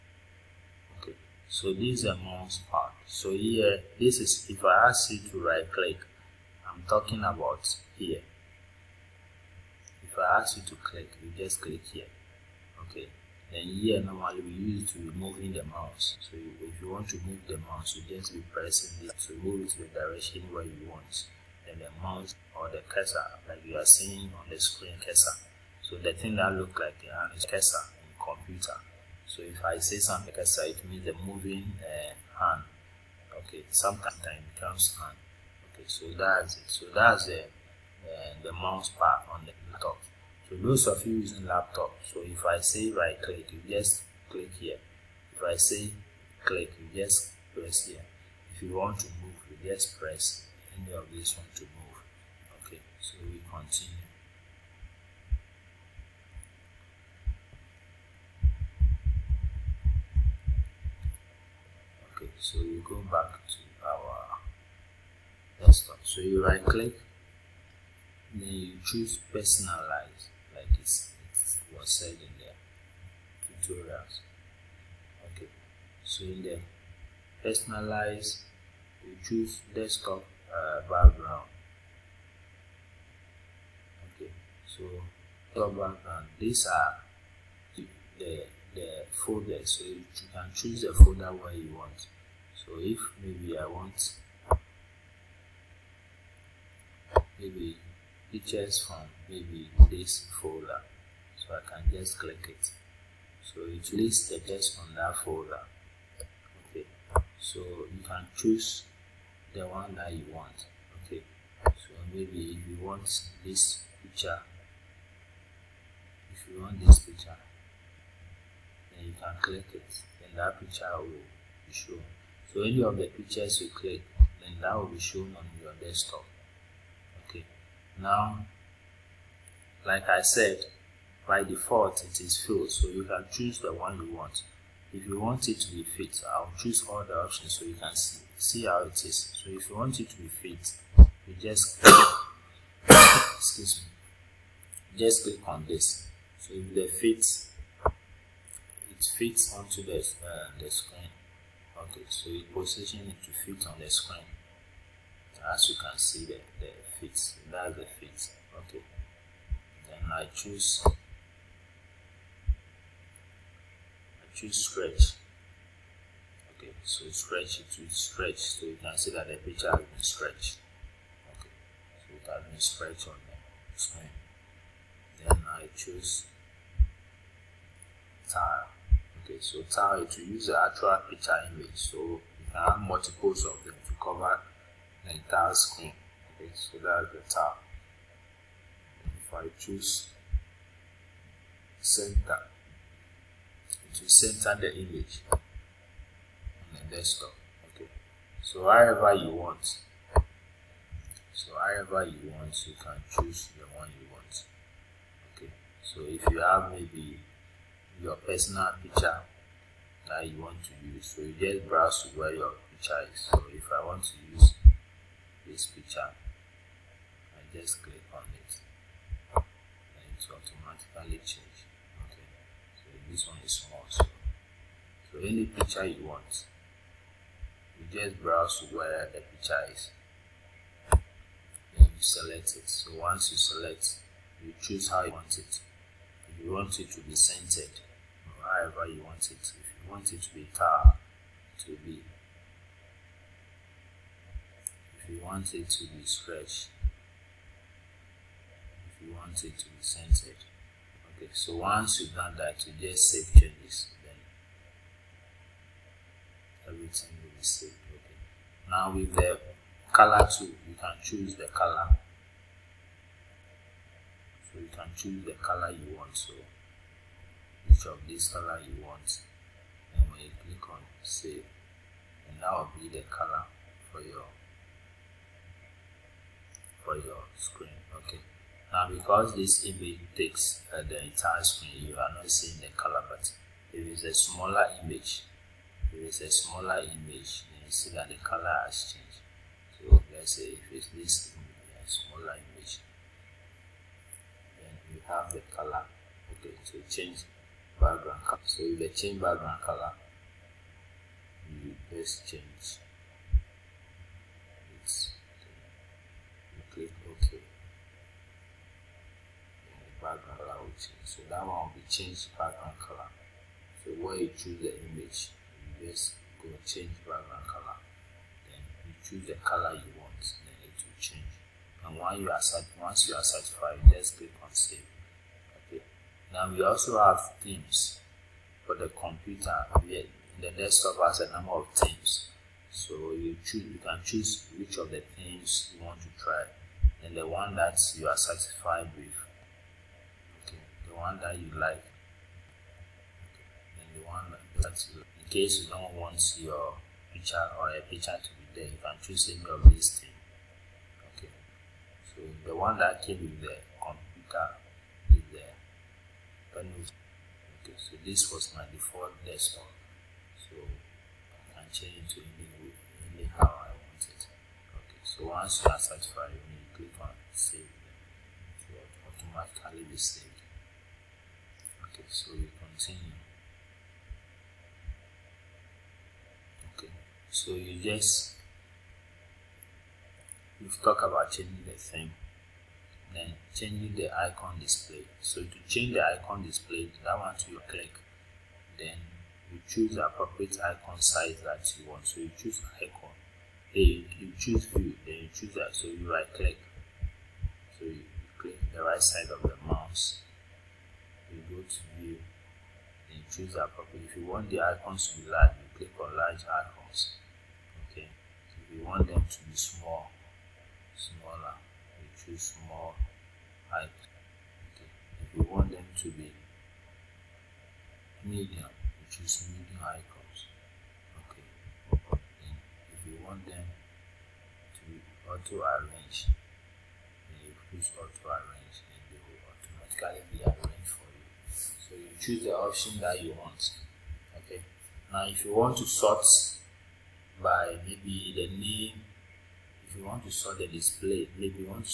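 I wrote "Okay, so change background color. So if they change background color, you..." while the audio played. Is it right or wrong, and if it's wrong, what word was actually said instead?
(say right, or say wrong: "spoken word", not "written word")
right.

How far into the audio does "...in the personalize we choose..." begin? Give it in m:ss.
1:16.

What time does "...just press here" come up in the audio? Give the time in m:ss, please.
0:47.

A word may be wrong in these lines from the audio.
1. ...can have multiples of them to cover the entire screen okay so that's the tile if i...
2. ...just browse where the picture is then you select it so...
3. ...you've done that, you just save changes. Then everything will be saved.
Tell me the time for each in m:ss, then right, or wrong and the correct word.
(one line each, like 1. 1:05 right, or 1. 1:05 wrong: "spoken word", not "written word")
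1. 3:02 right
2. 3:47 right
3. 4:12 right.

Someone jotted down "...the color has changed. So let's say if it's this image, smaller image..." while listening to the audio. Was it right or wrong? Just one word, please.
right.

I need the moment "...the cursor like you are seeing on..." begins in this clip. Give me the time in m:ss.
0:22.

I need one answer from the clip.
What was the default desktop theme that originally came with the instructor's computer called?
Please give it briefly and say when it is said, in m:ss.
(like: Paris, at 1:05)
the panel, at 5:55.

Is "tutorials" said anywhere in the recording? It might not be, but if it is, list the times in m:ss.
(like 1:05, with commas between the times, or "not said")
1:13.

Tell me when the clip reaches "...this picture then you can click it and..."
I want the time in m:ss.
1:56.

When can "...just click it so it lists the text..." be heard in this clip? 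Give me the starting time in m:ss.
1:41.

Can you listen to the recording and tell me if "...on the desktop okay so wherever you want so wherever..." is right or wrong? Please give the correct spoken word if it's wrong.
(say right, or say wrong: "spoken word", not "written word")
right.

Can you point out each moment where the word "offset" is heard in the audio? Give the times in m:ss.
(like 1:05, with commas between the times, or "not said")
not said.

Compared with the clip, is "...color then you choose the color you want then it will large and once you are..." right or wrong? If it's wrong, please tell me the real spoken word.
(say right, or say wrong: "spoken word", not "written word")
wrong: "change", not "large".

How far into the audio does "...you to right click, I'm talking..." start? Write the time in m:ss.
0:05.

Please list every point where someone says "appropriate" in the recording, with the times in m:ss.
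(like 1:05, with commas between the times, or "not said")
6:30, 6:43.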